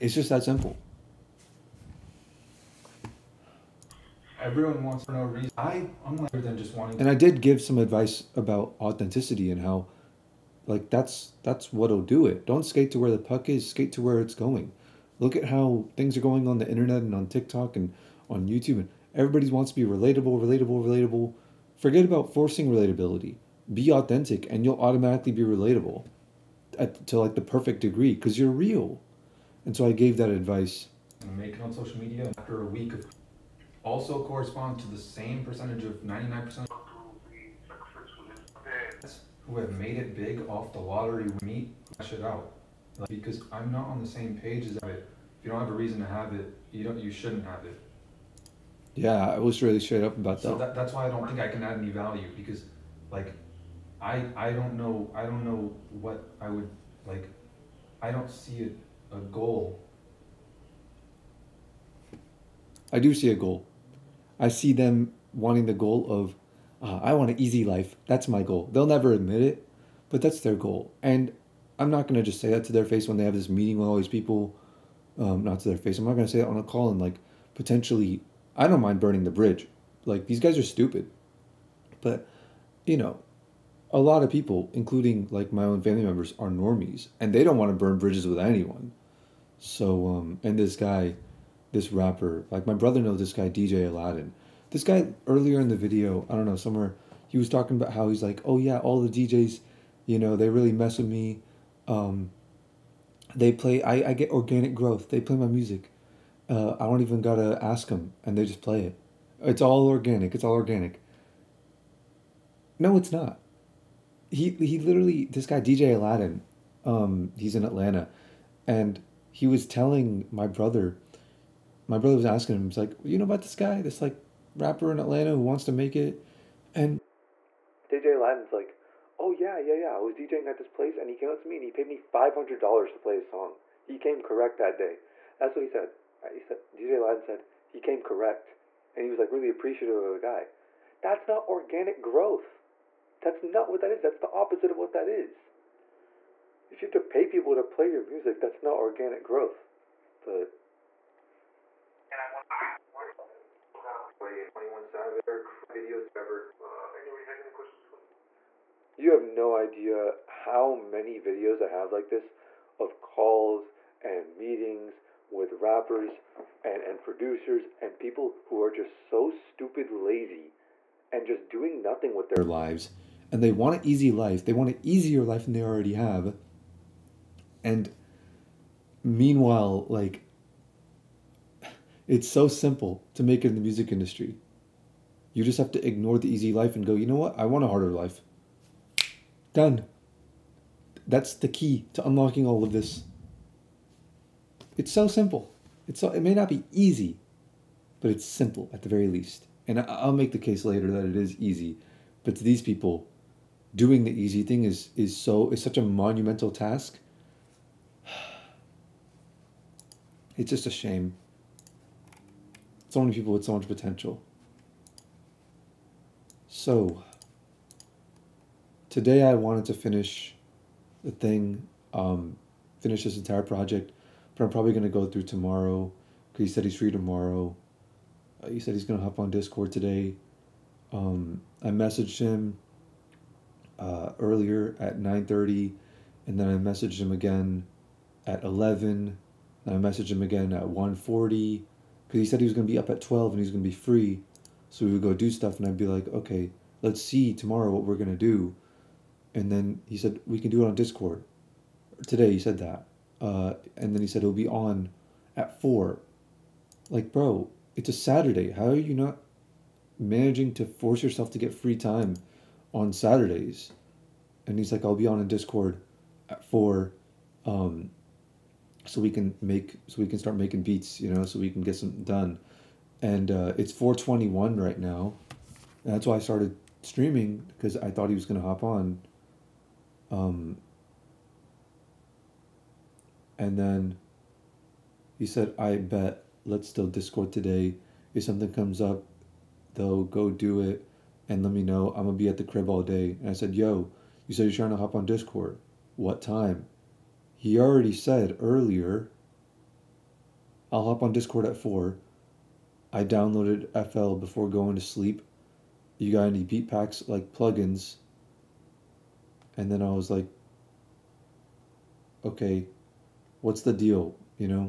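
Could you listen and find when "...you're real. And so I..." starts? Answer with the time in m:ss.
0:28.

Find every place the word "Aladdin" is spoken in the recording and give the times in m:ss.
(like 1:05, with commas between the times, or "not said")
1:33, 1:55, 2:08, 2:16.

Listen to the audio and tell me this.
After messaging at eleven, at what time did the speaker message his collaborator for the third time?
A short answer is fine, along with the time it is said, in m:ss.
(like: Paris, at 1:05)
1:40, at 4:00.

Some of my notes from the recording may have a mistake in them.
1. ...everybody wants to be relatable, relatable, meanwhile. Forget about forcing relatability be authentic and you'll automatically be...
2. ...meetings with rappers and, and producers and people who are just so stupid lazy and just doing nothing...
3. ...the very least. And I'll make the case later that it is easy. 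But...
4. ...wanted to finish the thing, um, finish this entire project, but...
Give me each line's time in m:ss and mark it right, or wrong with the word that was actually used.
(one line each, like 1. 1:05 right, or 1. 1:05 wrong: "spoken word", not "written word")
1. 0:19 wrong: "relatable", not "meanwhile"
2. 2:44 right
3. 3:18 right
4. 3:39 right.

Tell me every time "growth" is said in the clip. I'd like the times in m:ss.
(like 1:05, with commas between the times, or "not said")
1:44, 2:22, 2:29.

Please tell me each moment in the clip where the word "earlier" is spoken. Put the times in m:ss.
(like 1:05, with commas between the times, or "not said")
1:35, 3:54, 4:58.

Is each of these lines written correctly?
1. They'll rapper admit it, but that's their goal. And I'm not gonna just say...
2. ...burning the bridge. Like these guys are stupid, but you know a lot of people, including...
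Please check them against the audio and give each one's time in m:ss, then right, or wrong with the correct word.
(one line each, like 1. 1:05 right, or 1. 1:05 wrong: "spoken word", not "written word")
1. 1:08 wrong: "never", not "rapper"
2. 1:18 right.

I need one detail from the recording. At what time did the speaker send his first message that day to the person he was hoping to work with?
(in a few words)
9:30.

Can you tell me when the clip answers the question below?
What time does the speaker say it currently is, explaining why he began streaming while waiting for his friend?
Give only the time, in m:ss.
4:33.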